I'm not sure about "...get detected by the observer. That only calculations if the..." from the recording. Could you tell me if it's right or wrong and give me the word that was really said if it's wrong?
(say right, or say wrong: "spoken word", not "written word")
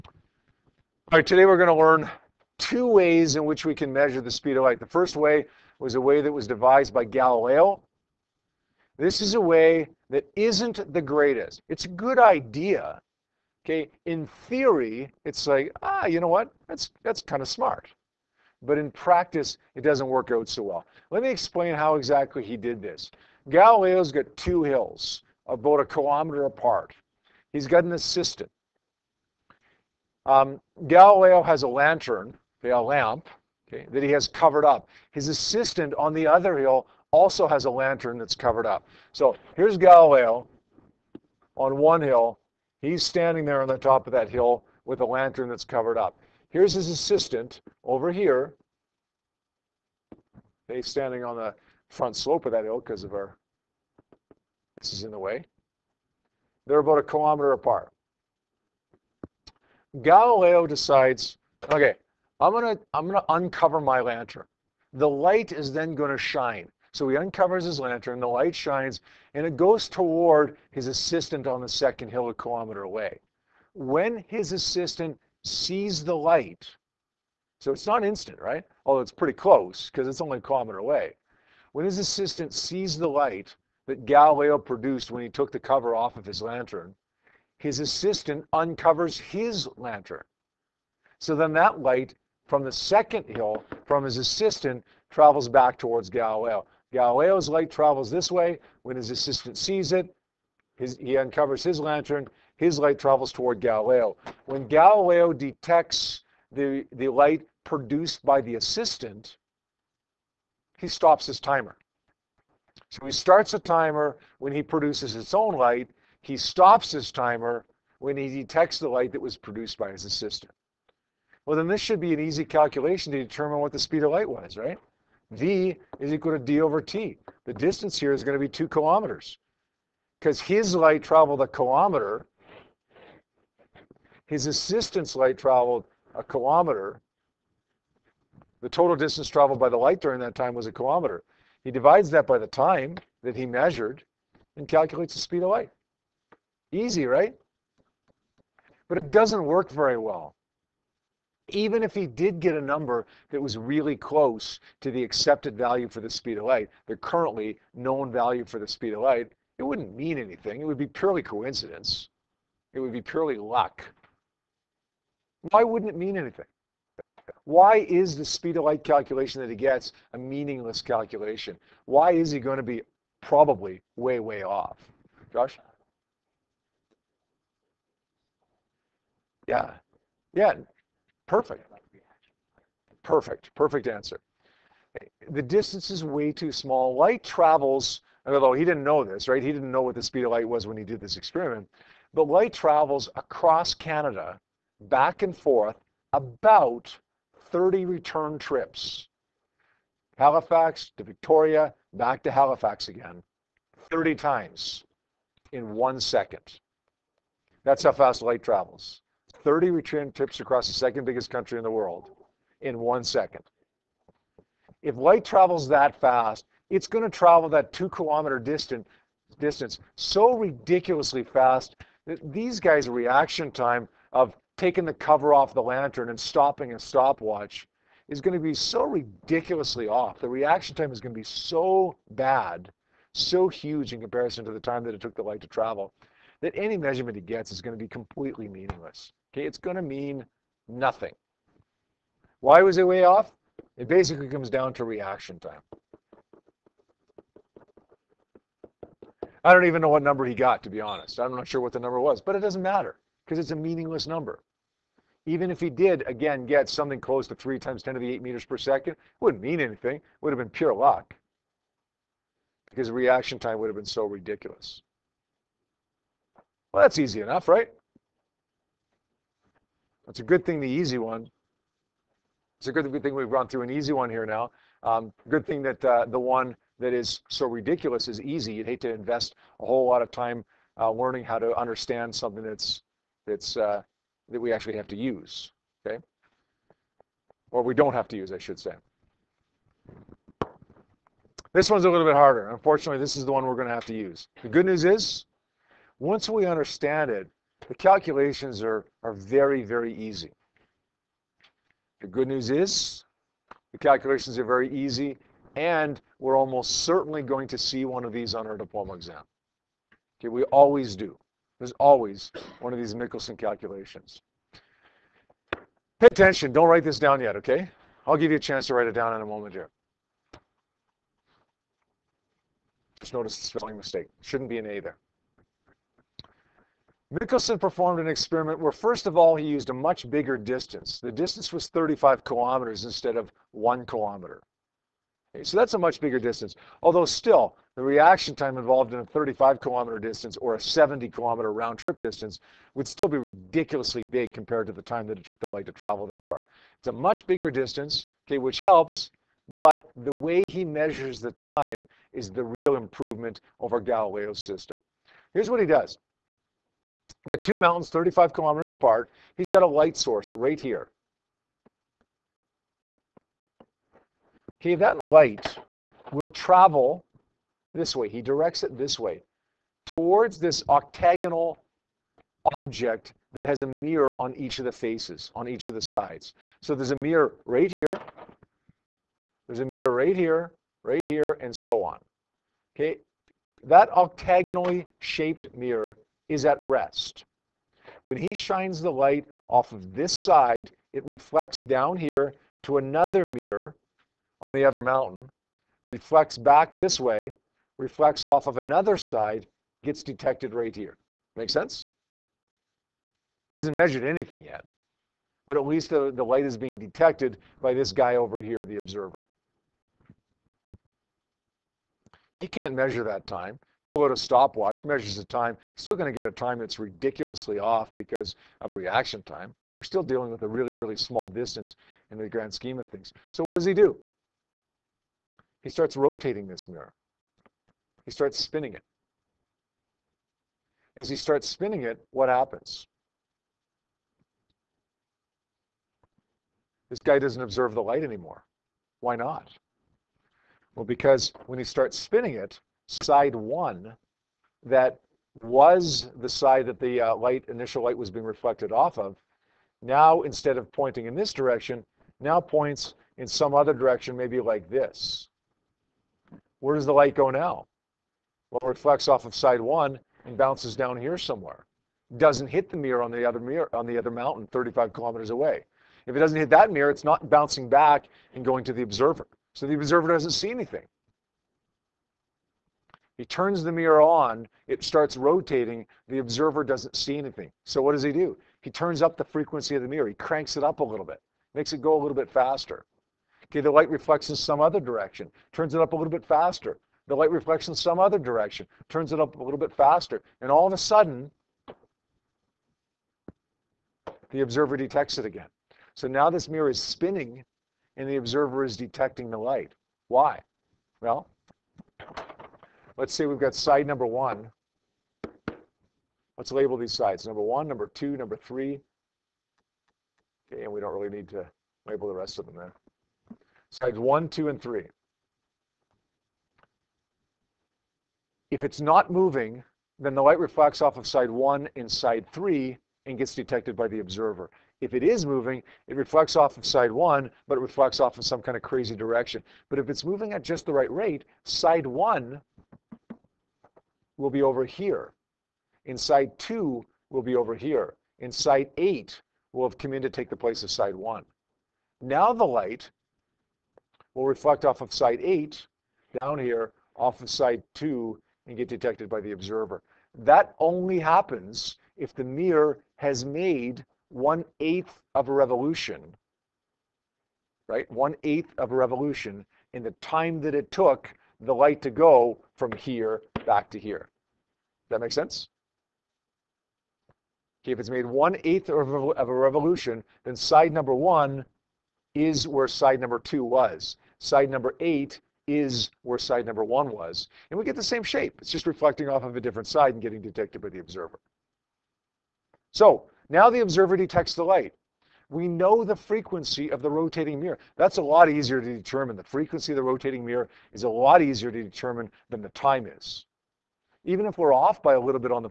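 wrong: "happens", not "calculations".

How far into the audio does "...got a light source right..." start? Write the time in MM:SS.
05:59.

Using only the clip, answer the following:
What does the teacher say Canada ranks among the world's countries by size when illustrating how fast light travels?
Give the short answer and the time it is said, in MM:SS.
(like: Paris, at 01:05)
Second biggest, at 03:30.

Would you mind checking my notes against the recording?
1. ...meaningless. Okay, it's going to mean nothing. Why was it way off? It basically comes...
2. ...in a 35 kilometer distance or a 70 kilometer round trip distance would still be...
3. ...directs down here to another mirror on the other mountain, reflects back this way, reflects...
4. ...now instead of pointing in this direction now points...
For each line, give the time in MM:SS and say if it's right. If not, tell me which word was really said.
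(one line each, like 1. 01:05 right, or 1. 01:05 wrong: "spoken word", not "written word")
1. 03:58 right
2. 05:38 right
3. 06:31 wrong: "reflects", not "directs"
4. 07:29 right.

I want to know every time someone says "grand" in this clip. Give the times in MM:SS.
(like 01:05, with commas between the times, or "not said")
07:02.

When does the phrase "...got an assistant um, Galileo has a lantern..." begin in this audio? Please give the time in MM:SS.
00:27.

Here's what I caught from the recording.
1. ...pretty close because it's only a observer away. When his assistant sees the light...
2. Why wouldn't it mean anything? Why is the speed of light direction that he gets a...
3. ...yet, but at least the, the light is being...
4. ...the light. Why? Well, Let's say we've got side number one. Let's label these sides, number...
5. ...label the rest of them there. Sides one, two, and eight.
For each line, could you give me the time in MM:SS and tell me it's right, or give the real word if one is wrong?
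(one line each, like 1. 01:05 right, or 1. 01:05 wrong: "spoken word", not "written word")
1. 01:19 wrong: "kilometer", not "observer"
2. 02:45 wrong: "calculation", not "direction"
3. 06:44 right
4. 08:19 right
5. 08:31 wrong: "three", not "eight".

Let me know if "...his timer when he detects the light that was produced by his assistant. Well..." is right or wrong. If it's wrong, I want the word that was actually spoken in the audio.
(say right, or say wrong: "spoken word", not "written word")
right.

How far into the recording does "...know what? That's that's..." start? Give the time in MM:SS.
00:16.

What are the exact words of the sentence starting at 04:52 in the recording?
Unfortunately, this is the one we're going to have to use.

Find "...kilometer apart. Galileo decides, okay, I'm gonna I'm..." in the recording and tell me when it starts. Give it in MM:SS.
00:57.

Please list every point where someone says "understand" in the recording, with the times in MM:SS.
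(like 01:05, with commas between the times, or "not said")
04:41, 04:56.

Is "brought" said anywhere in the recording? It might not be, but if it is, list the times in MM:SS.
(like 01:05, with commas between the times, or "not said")
not said.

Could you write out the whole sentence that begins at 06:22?
Okay, that octagonally shaped mirror is at rest.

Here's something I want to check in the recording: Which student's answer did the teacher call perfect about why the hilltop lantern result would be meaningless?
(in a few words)
Josh.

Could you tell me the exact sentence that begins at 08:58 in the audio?
In site eight will have come in to take the place of site one.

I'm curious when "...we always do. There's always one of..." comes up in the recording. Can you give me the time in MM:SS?
05:10.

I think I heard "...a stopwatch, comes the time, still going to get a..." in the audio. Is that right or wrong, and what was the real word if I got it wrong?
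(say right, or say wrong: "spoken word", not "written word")
wrong: "measures", not "comes".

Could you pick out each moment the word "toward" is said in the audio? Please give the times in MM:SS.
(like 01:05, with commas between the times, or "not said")
01:09, 01:35, 01:43, 06:09.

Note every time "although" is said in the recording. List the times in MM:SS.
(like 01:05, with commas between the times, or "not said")
01:18, 03:08, 05:36.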